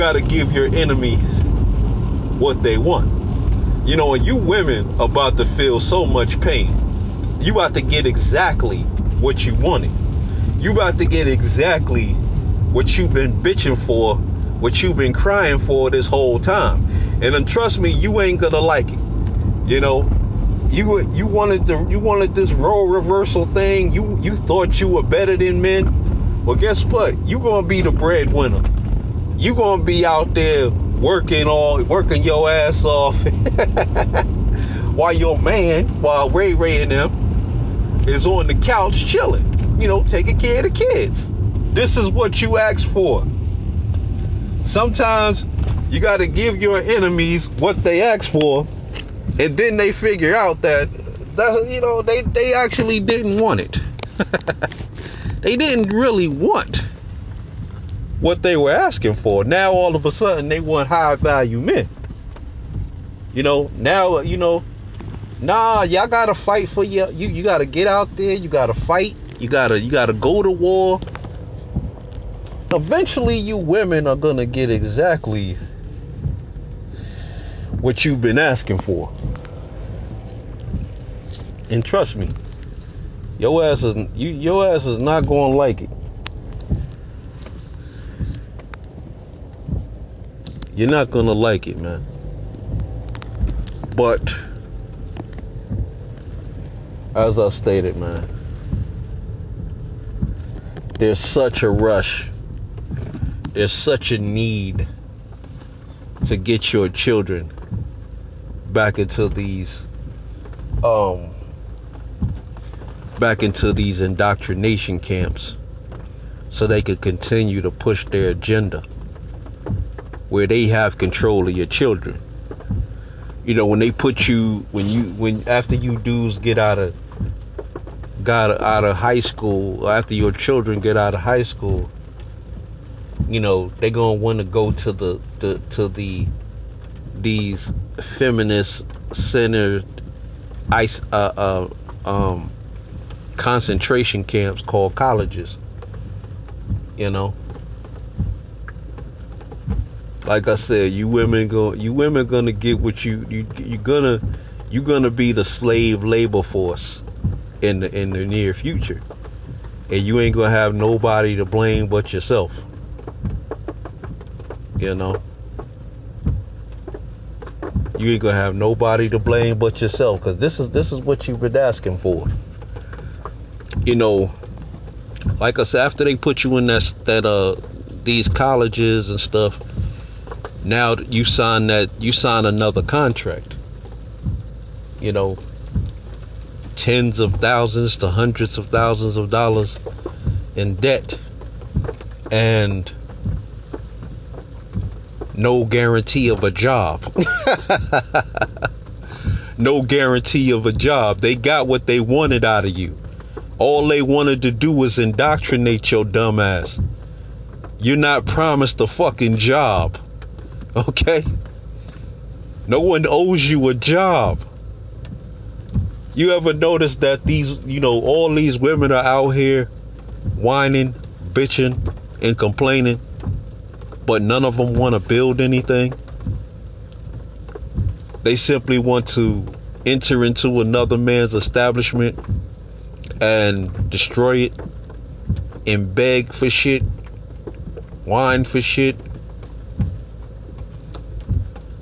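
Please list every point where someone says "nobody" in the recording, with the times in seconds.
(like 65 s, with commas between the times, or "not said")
160 s, 168 s.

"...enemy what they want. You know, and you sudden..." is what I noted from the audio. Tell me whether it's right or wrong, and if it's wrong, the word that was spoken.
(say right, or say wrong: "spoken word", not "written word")
wrong: "women", not "sudden".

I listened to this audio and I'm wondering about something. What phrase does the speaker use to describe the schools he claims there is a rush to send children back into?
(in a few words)
indoctrination camps.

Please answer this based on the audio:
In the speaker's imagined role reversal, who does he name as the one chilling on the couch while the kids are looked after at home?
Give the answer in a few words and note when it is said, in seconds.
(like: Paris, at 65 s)
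Ray Ray, at 36 s.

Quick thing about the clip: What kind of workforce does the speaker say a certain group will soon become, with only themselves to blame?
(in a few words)
slave labor force.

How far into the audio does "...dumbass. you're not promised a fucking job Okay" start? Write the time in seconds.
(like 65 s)
206 s.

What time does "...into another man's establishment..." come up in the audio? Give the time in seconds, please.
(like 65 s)
230 s.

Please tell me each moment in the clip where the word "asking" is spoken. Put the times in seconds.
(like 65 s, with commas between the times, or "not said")
58 s, 78 s, 171 s.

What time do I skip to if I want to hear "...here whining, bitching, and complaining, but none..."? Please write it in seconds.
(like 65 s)
219 s.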